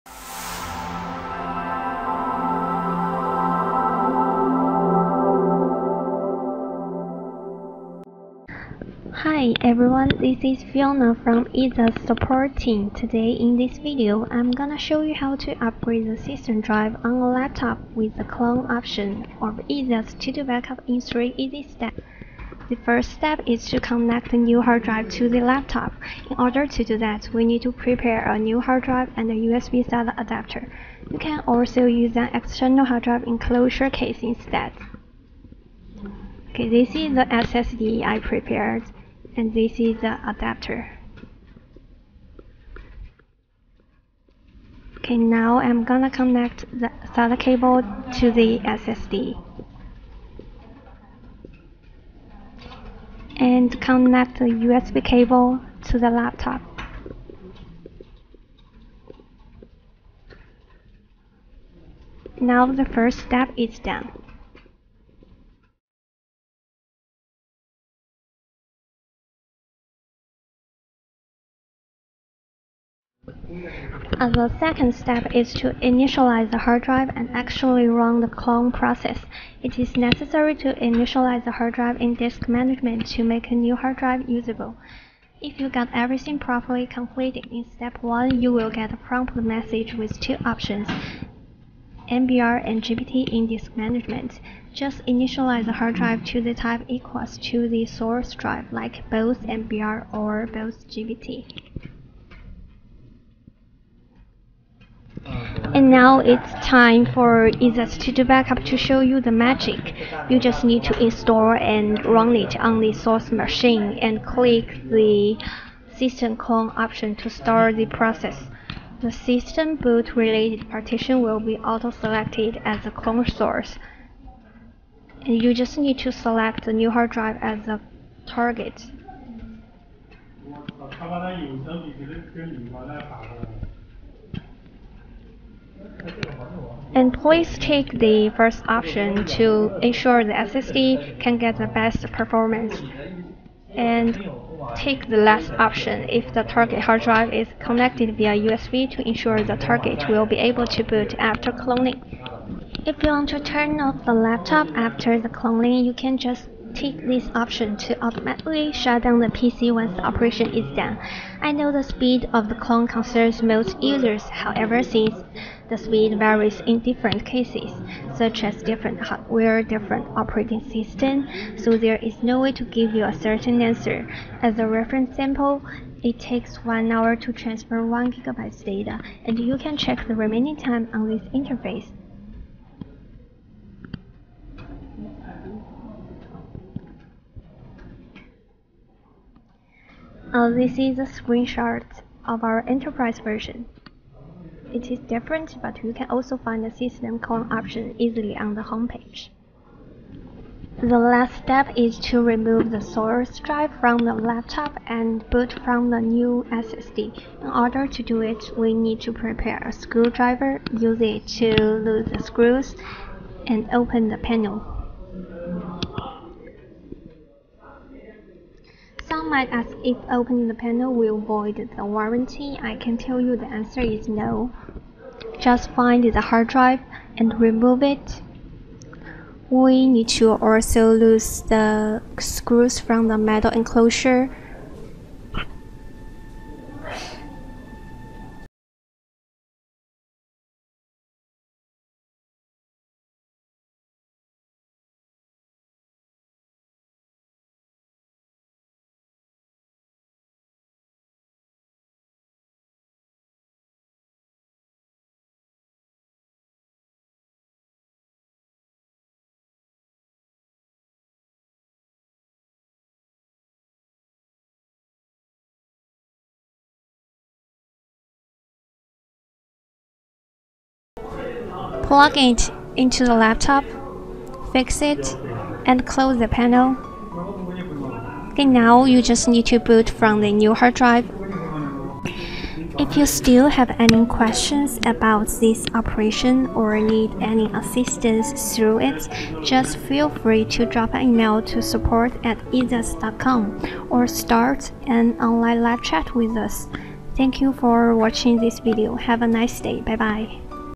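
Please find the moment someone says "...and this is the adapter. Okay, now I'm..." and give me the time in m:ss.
0:39.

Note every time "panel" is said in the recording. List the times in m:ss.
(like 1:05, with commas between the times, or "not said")
3:34, 3:40, 4:36.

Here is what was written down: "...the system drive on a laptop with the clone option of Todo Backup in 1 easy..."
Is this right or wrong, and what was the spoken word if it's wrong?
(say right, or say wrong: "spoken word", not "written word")
wrong: "3", not "1".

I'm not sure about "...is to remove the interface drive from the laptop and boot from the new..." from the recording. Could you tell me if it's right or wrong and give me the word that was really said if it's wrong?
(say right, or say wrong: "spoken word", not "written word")
wrong: "source", not "interface".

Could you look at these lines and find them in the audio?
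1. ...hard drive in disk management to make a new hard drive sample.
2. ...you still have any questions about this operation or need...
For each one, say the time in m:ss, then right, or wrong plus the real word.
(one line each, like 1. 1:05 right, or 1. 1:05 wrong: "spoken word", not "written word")
1. 1:21 wrong: "usable", not "sample"
2. 4:42 right.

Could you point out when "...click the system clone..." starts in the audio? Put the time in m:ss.
1:54.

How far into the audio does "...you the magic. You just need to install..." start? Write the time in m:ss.
1:48.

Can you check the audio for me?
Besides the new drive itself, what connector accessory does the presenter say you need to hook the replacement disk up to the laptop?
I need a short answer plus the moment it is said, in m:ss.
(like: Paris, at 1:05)
USB SATA adapter, at 0:29.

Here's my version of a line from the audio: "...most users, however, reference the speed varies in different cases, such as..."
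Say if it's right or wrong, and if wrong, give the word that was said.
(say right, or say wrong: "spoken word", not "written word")
wrong: "since", not "reference".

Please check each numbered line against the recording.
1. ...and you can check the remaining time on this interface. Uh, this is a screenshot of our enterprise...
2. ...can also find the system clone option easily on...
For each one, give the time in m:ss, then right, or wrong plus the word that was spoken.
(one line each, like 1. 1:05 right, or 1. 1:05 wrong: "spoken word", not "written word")
1. 2:59 right
2. 3:15 right.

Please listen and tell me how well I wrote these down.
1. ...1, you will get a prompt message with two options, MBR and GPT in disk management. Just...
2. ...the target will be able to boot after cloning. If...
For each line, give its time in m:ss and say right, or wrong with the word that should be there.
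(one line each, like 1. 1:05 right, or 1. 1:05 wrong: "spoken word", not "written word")
1. 1:28 right
2. 2:29 right.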